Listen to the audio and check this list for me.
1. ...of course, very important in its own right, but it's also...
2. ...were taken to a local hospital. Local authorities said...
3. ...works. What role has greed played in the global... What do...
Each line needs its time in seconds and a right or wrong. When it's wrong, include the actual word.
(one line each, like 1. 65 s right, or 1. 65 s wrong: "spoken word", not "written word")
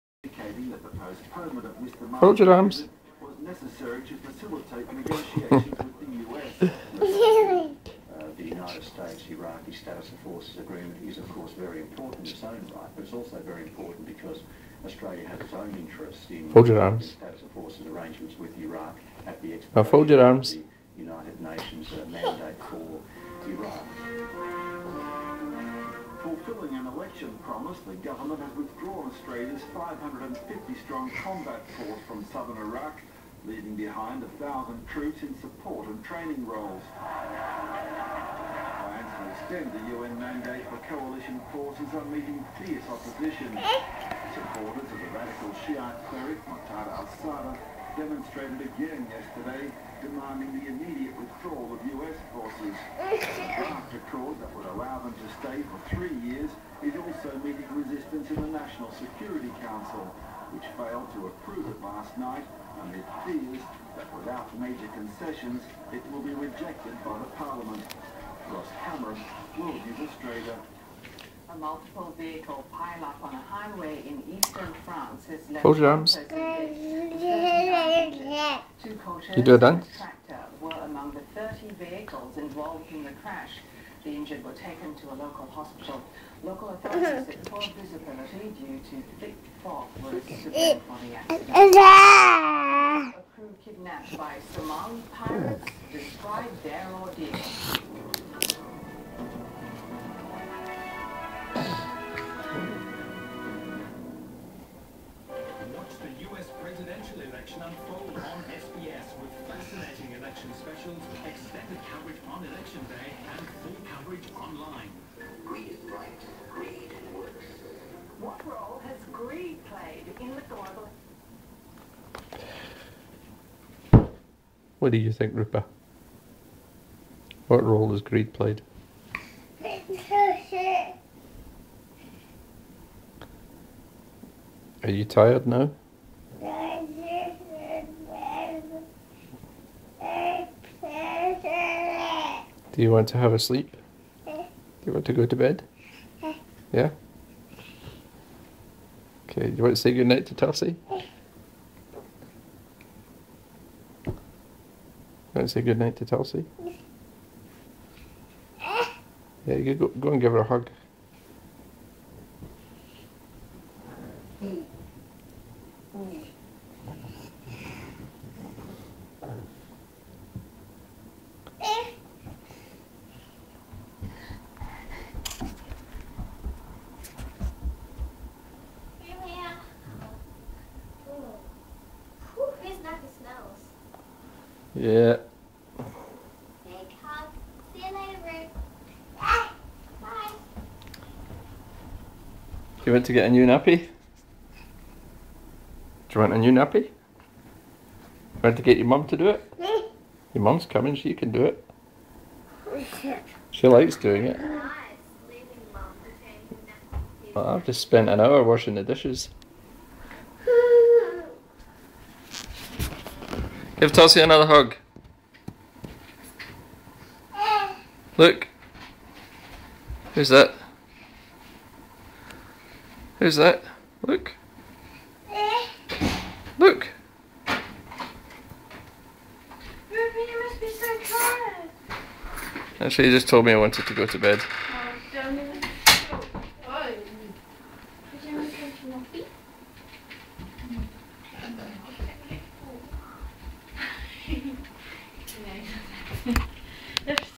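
1. 11 s right
2. 84 s right
3. 117 s right.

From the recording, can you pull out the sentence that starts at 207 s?
I've just spent an hour washing the dishes.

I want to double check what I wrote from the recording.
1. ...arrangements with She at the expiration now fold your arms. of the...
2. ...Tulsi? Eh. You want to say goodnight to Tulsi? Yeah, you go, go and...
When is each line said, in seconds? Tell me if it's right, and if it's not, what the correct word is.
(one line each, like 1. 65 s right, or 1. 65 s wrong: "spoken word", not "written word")
1. 17 s wrong: "Iraq", not "She"
2. 150 s right.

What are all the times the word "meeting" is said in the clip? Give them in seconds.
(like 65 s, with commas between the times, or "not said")
42 s, 57 s.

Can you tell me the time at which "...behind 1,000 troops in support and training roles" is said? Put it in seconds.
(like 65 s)
33 s.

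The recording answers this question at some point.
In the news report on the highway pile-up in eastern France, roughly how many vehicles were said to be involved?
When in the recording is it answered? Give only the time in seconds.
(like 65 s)
81 s.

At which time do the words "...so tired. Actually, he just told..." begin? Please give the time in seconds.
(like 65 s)
230 s.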